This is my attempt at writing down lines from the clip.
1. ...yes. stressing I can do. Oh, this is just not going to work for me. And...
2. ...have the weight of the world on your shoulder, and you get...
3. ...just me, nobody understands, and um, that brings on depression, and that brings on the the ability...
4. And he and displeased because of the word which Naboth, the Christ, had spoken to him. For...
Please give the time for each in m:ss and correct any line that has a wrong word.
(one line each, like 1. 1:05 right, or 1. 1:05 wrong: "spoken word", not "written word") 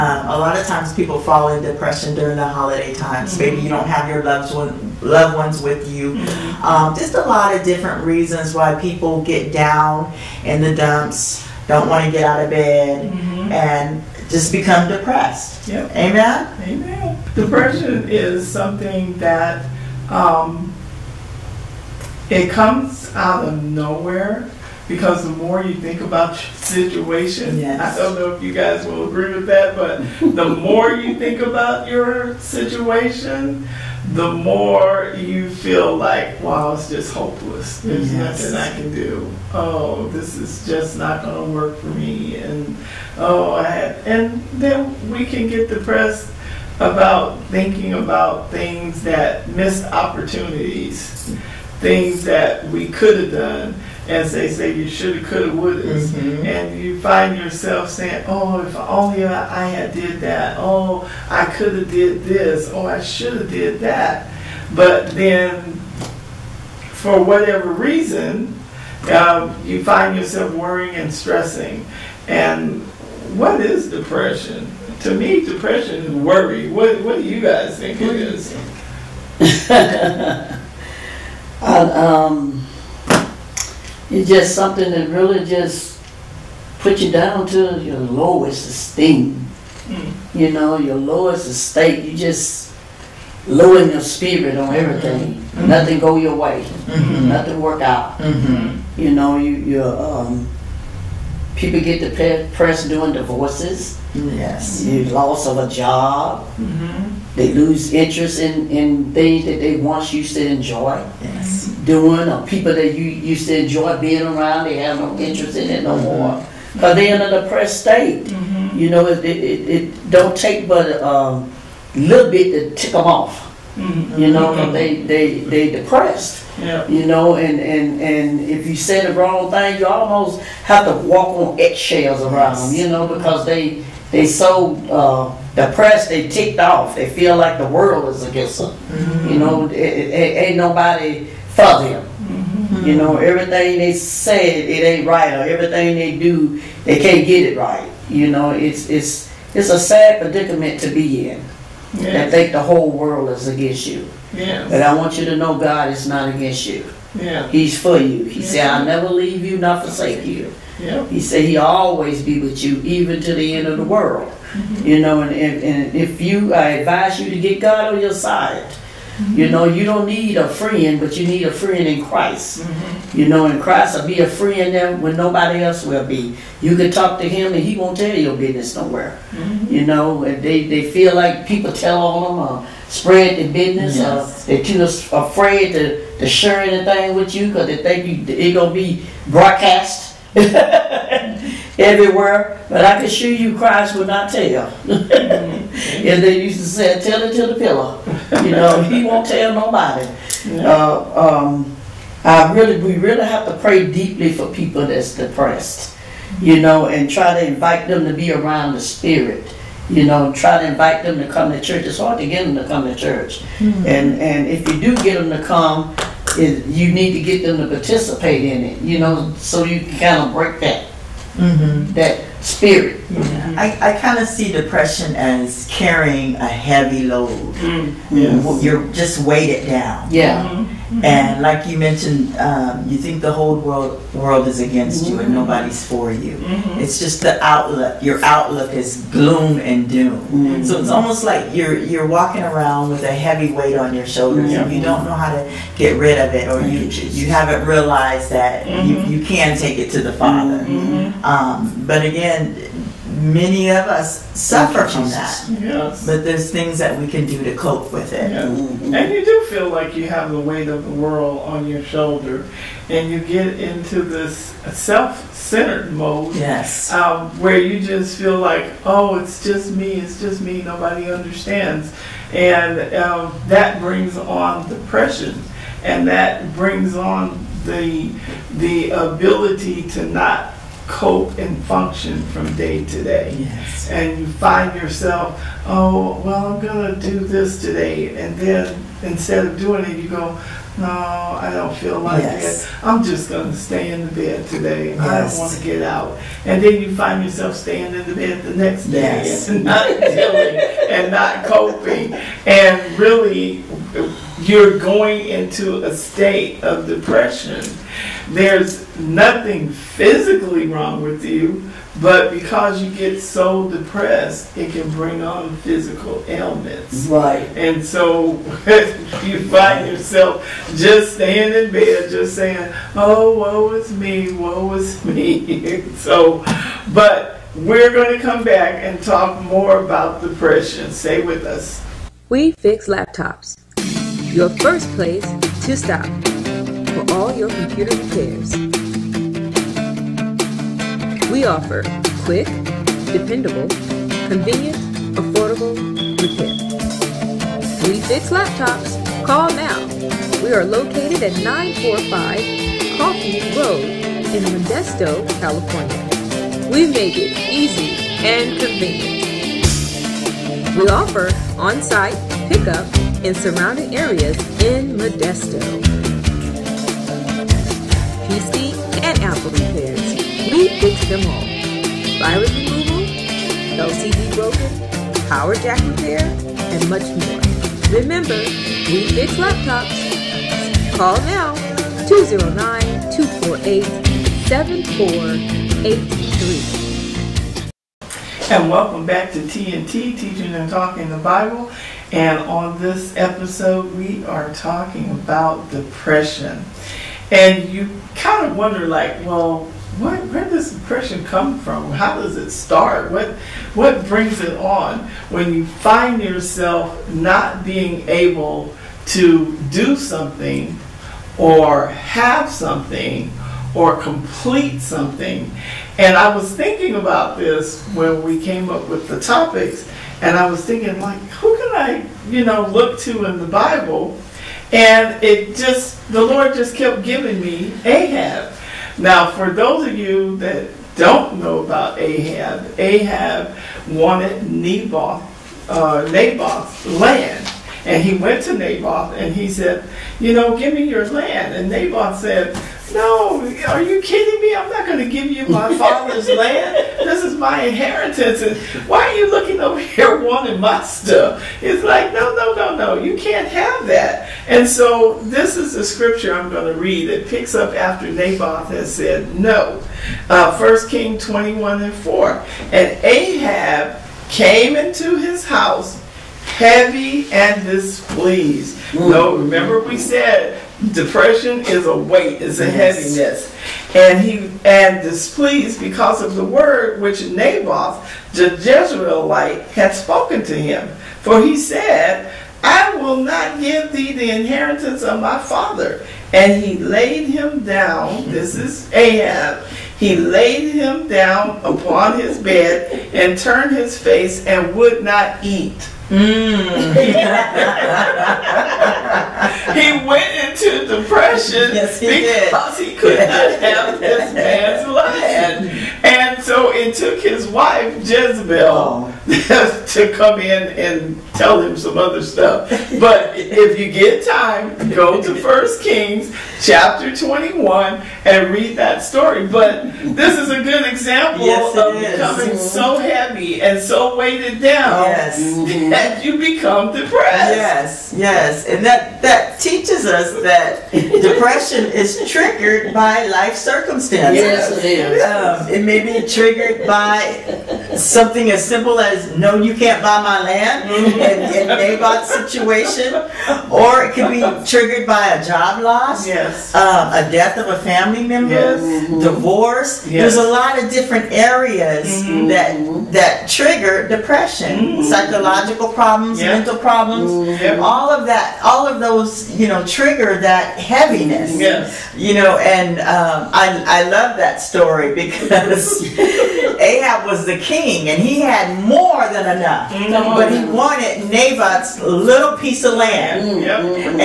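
1. 0:38 wrong: "nothing", not "stressing"
2. 4:20 right
3. 4:30 right
4. 7:53 wrong: "Jezreelite", not "Christ".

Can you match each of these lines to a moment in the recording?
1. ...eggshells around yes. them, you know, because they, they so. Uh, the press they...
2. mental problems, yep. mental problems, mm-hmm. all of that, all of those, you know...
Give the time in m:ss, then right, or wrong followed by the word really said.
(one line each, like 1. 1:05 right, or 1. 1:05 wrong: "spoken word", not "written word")
1. 2:11 right
2. 9:15 wrong: "psychological", not "mental".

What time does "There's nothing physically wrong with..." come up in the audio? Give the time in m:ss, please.
5:08.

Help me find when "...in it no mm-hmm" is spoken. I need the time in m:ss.
1:55.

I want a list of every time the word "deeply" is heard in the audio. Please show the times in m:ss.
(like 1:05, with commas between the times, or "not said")
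3:23.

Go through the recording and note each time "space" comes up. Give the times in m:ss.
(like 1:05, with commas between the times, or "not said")
not said.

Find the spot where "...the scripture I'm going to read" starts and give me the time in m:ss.
7:35.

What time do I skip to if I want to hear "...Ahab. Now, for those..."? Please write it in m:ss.
7:07.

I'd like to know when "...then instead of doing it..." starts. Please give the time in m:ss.
4:48.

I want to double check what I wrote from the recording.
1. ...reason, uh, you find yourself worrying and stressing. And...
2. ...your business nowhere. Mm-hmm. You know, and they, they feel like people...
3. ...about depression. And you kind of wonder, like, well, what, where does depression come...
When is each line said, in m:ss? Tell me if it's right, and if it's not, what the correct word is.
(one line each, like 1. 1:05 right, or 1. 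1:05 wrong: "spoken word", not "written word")
1. 1:07 right
2. 2:58 right
3. 6:35 right.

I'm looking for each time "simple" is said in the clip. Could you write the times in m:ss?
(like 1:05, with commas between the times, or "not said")
8:58.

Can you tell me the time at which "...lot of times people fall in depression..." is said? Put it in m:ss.
0:00.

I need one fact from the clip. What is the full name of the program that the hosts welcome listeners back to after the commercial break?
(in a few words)
Teaching and Talking the Bible.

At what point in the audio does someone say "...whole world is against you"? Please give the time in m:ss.
2:32.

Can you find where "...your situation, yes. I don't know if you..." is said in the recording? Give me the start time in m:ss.
0:26.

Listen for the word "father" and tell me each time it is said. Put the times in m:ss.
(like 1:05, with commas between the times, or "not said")
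4:10, 7:25, 8:05.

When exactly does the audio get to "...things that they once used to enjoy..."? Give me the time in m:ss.
1:49.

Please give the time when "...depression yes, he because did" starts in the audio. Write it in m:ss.
8:20.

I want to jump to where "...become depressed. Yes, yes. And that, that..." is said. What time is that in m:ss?
8:46.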